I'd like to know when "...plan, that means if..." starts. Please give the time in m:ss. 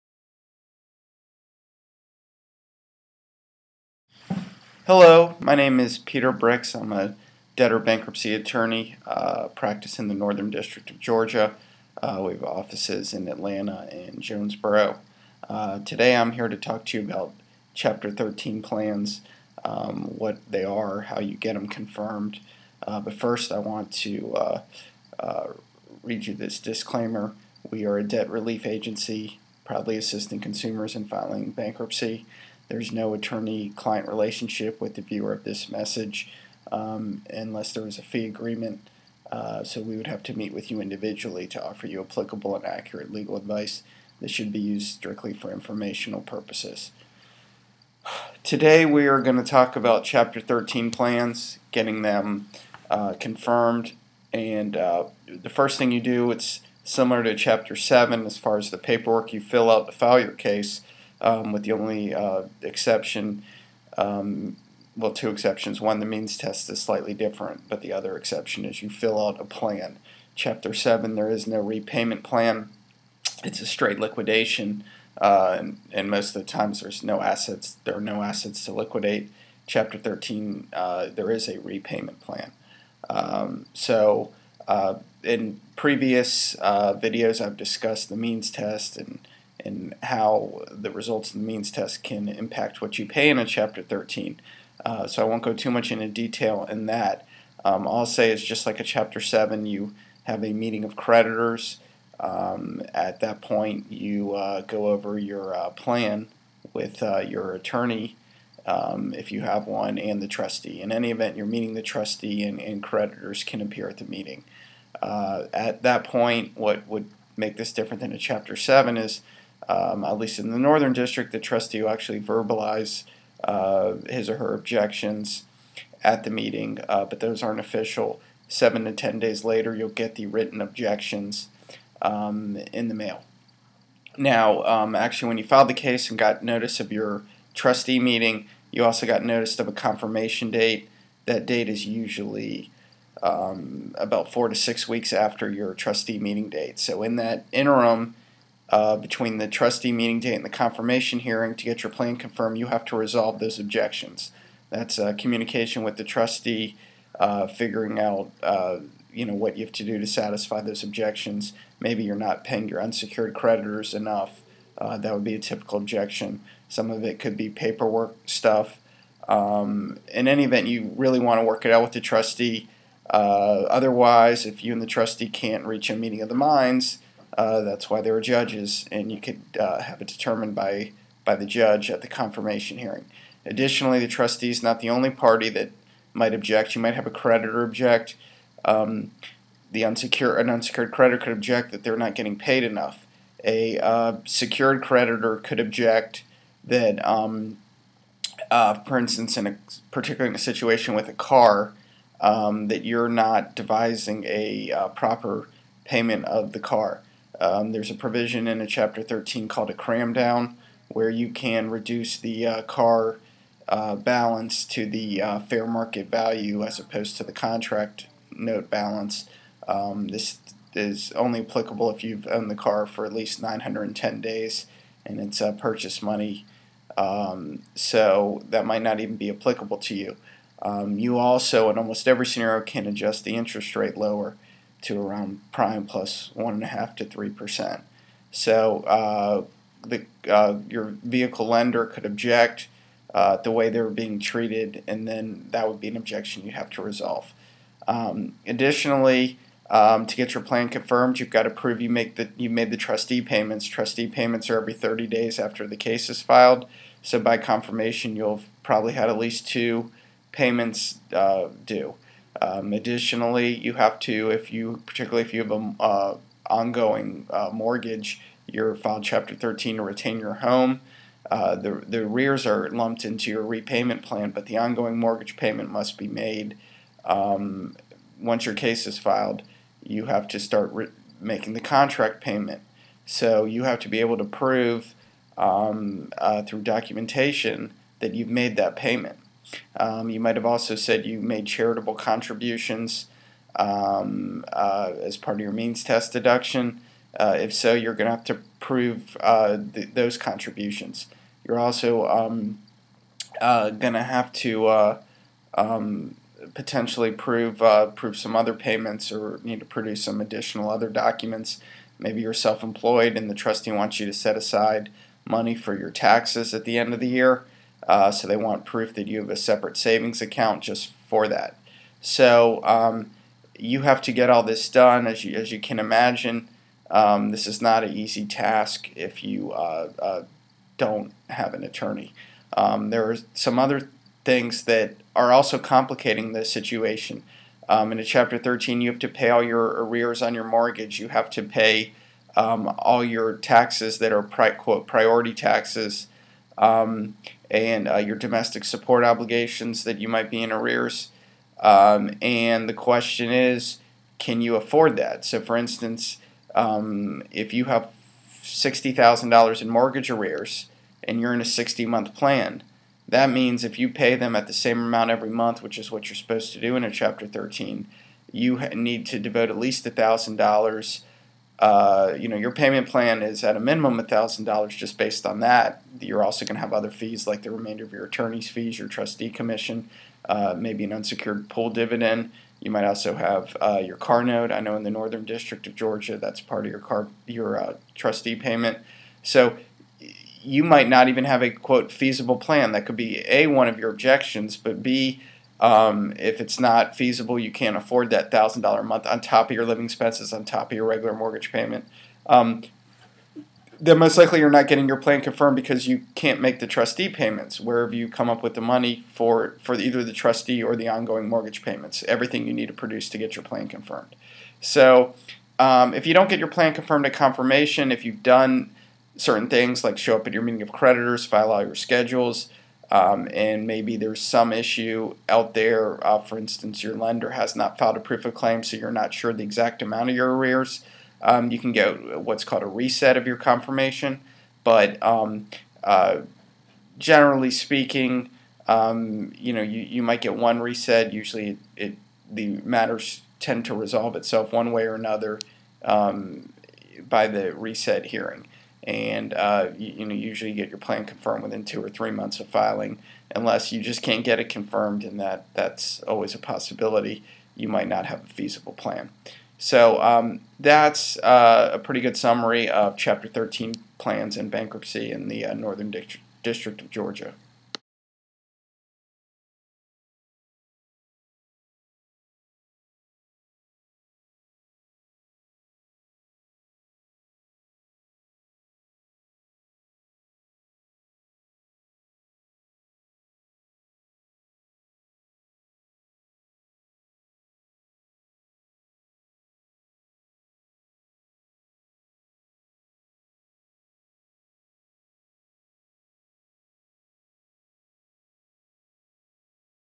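6:02.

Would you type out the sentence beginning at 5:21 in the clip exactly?
So um, you have to get all this done, as you, as you can imagine.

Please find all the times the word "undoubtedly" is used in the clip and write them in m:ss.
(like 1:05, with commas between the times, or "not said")
not said.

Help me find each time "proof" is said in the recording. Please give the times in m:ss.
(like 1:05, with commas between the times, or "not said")
5:18, 7:08.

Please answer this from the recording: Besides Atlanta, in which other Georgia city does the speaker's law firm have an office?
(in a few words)
Jonesboro.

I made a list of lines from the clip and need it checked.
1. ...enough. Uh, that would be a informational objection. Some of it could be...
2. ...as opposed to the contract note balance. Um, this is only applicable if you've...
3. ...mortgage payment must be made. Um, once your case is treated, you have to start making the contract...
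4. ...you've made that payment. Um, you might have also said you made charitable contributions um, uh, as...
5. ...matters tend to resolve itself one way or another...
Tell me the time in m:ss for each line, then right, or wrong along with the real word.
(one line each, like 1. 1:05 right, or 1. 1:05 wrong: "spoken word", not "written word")
1. 2:43 wrong: "typical", not "informational"
2. 3:36 right
3. 4:34 wrong: "filed", not "treated"
4. 4:48 right
5. 7:22 right.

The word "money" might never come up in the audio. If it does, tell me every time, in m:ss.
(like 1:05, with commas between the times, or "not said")
3:46, 5:15, 6:48.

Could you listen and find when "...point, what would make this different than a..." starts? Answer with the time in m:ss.
1:56.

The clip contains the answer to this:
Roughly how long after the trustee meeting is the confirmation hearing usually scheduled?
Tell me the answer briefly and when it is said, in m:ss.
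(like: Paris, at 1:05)
4 to 6 weeks, at 2:24.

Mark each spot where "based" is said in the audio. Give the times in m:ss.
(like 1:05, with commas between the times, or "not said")
6:14.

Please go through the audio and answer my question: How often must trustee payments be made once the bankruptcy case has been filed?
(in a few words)
every 30 days.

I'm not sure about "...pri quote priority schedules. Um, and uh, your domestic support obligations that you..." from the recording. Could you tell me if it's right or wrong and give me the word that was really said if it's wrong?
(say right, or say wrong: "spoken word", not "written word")
wrong: "taxes", not "schedules".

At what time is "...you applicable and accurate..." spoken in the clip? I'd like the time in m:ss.
0:41.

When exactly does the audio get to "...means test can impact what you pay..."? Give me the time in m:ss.
1:31.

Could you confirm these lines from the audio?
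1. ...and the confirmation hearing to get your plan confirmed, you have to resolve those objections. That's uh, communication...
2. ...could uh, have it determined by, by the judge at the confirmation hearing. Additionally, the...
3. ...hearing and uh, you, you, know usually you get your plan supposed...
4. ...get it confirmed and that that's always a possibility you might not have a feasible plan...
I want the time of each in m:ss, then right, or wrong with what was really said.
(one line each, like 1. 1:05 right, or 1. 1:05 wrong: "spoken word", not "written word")
1. 2:30 right
2. 2:59 right
3. 7:28 wrong: "confirmed", not "supposed"
4. 7:34 right.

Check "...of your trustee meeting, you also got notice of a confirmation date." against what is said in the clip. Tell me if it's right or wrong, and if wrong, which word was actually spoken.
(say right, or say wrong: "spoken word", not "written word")
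right.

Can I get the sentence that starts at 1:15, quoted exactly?
Uh, and, and, most of the times there's no assets, there are no assets to liquidate.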